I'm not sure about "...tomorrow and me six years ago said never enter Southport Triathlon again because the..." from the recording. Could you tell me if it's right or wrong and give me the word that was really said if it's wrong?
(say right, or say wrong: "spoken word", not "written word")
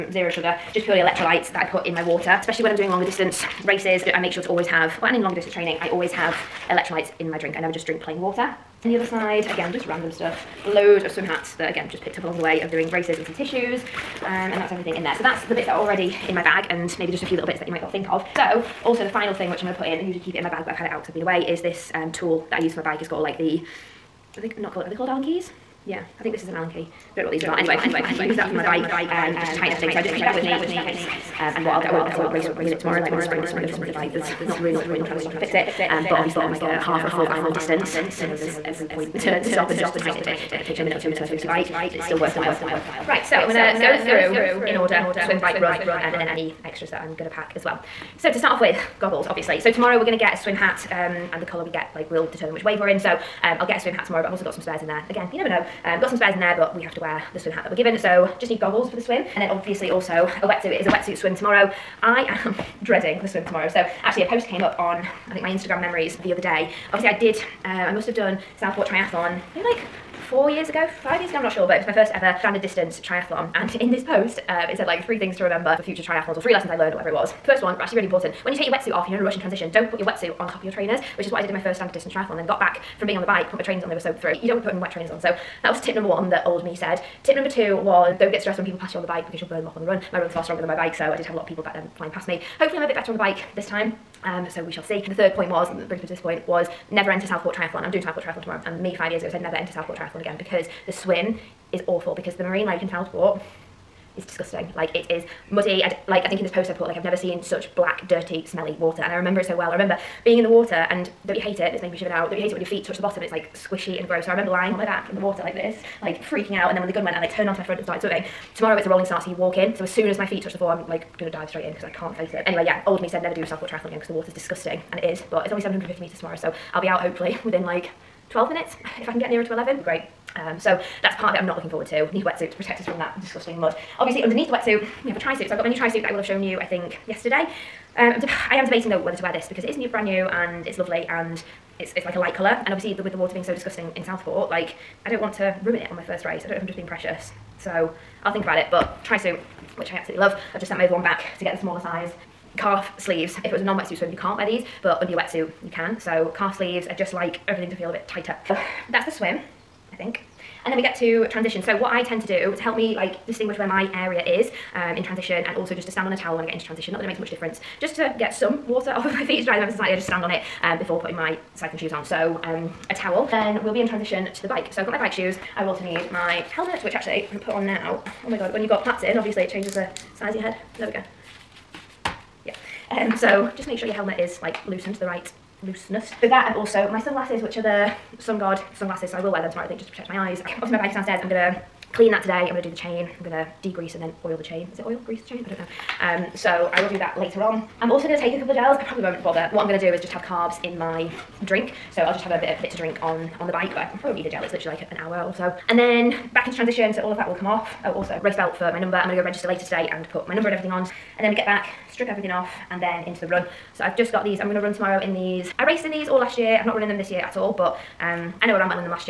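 wrong: "five", not "six".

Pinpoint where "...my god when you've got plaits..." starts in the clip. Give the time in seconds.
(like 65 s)
178 s.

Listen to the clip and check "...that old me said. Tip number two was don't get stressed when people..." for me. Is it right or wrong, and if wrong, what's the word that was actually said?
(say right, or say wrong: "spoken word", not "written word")
right.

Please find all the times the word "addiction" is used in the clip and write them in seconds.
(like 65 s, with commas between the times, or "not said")
not said.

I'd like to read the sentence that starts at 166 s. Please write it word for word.
Not that it makes much difference.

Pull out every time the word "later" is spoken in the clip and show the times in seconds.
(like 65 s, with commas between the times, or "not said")
197 s, 209 s.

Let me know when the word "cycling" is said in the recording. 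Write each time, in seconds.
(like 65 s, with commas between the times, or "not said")
171 s.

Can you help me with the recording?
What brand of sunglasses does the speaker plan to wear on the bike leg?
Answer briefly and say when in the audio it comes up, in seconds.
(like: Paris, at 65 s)
SunGod, at 188 s.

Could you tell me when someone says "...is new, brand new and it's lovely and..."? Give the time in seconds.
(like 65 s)
139 s.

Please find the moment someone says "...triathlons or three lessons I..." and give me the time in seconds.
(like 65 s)
76 s.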